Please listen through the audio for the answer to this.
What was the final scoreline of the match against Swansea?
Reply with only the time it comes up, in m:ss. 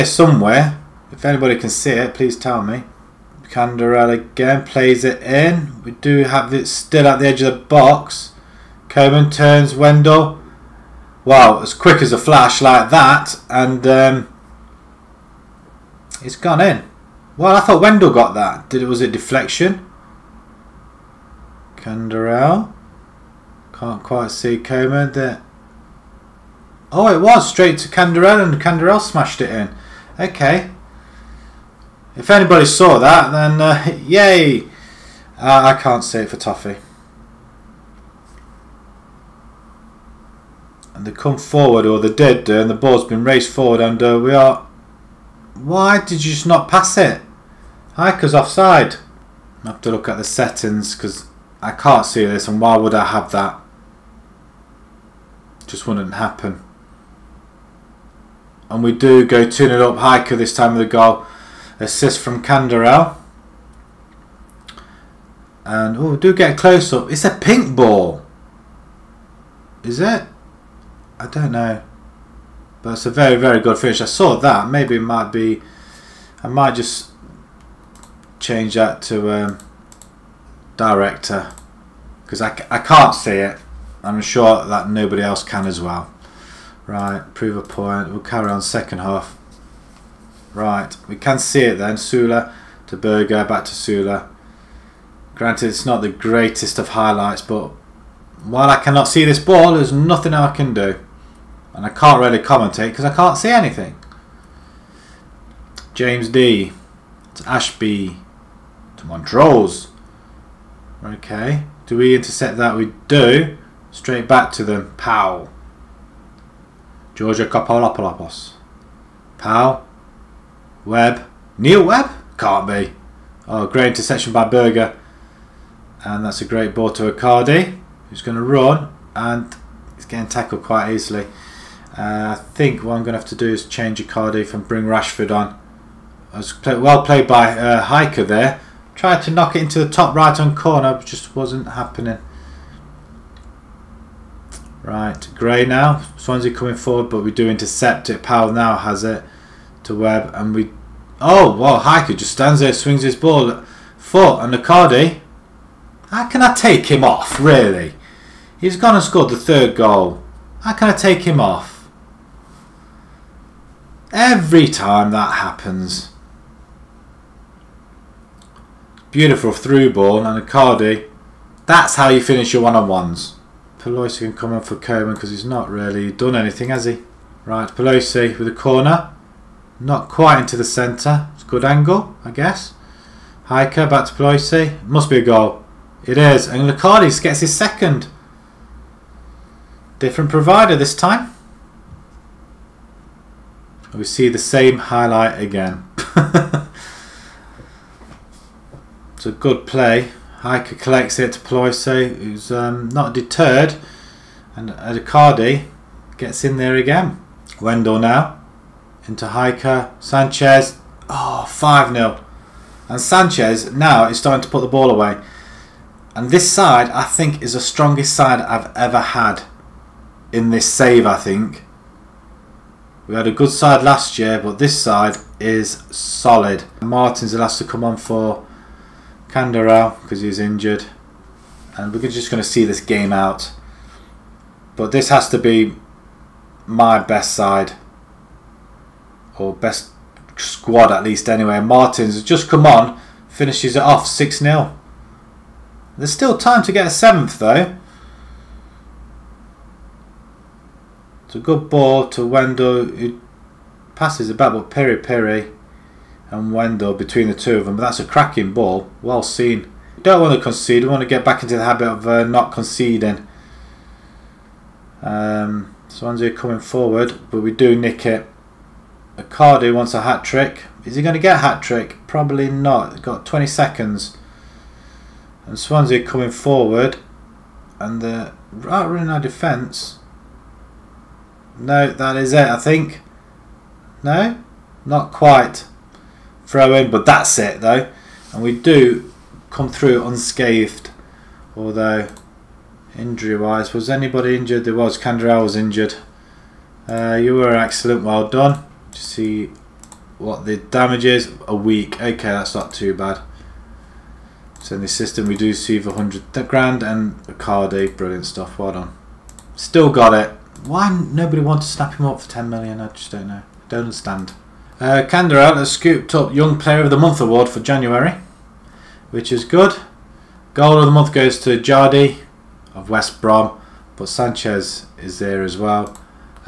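4:04.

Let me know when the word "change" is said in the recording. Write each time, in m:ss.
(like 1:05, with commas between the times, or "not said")
1:18, 2:13.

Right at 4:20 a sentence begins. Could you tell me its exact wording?
We want to get back into the habit of uh, not conceding.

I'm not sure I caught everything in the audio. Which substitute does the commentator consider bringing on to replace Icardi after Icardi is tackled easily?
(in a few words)
Rashford.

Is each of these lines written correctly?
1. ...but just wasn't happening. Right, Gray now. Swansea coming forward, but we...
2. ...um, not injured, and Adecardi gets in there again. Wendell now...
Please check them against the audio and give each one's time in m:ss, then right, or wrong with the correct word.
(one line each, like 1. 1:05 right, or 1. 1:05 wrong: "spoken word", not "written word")
1. 2:20 right
2. 3:22 wrong: "deterred", not "injured".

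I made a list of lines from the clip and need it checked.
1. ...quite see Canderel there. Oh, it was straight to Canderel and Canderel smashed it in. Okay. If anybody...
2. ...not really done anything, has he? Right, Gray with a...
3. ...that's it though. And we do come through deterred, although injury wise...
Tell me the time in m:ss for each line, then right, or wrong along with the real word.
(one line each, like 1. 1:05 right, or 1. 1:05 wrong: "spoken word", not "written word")
1. 0:24 wrong: "Coman", not "Canderel"
2. 2:55 wrong: "Pelosi", not "Gray"
3. 4:47 wrong: "unscathed", not "deterred".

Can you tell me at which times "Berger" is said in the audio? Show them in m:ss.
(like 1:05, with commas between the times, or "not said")
1:32, 2:04.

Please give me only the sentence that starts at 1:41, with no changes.
And I can't really commentate because I can't see anything.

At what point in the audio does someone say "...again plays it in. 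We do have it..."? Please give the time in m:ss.
0:04.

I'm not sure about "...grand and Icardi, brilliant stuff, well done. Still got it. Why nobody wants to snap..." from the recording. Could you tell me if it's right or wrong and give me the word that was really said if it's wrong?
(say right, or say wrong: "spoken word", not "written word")
right.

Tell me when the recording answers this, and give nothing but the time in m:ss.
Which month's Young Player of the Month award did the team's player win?
5:17.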